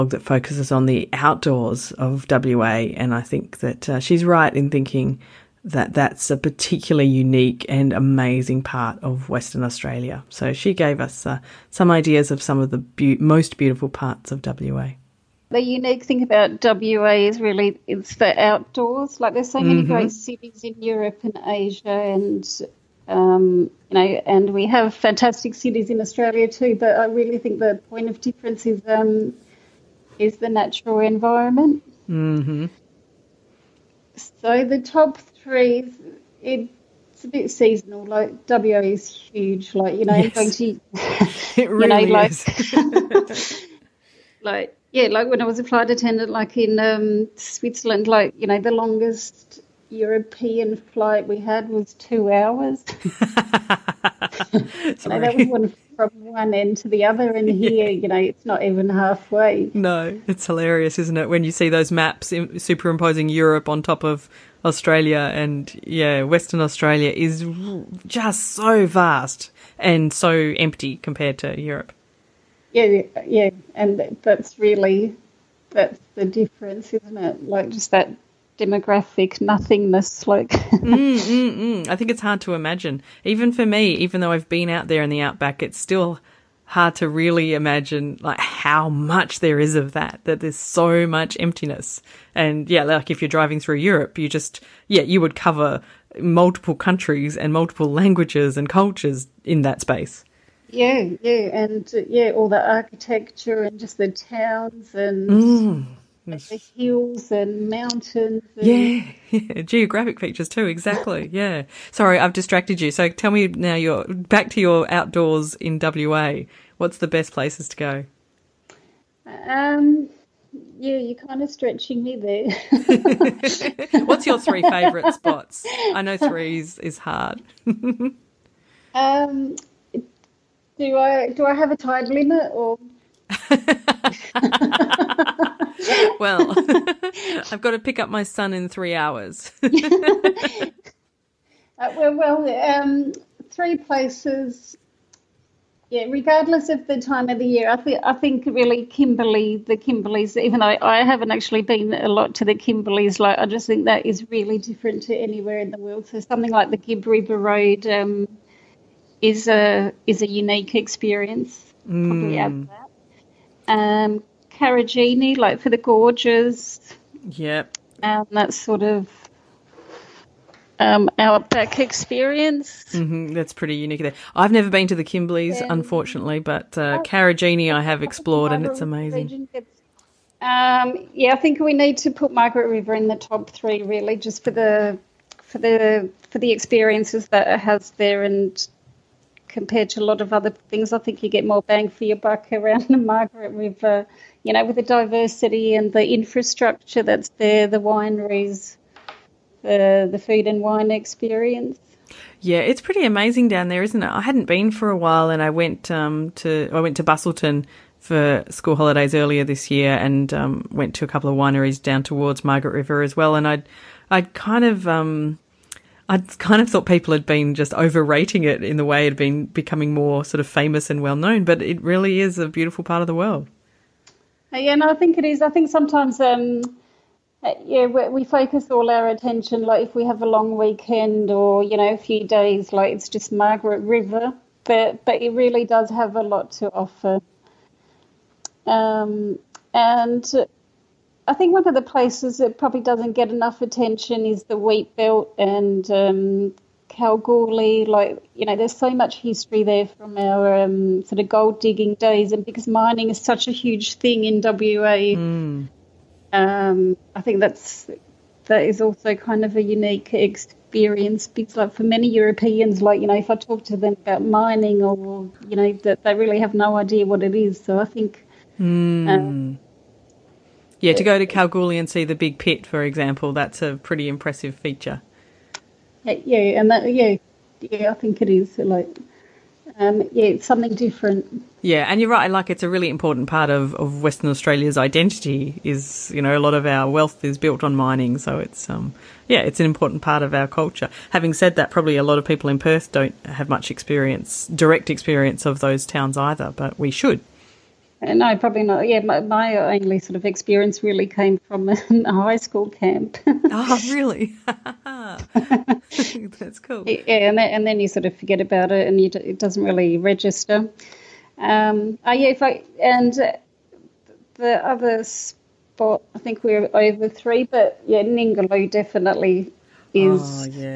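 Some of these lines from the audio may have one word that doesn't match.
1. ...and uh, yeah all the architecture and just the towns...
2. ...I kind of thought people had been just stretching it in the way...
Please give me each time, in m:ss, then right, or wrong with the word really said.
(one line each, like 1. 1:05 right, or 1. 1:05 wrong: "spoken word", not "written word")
1. 1:41 right
2. 3:36 wrong: "overrating", not "stretching".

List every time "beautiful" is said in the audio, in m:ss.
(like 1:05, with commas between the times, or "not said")
0:13, 3:42.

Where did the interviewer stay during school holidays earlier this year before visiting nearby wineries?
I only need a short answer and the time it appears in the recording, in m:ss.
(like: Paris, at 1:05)
Busselton, at 3:27.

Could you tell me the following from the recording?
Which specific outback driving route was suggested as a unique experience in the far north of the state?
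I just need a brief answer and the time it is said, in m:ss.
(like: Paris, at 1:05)
Gibb River Road, at 2:36.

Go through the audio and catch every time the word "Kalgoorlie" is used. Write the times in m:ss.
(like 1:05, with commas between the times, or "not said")
4:06, 4:31.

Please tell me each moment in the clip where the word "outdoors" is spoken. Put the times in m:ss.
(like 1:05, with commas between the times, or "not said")
0:01, 0:18, 1:54.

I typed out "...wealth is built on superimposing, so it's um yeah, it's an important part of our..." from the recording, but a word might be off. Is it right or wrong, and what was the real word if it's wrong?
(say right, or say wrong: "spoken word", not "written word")
wrong: "mining", not "superimposing".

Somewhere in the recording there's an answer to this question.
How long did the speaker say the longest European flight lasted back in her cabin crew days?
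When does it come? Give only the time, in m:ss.
0:51.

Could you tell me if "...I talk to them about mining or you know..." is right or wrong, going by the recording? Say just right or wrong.
right.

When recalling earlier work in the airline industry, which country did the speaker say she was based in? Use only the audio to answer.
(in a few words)
Switzerland.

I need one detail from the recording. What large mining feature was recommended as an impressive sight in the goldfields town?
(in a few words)
the big pit.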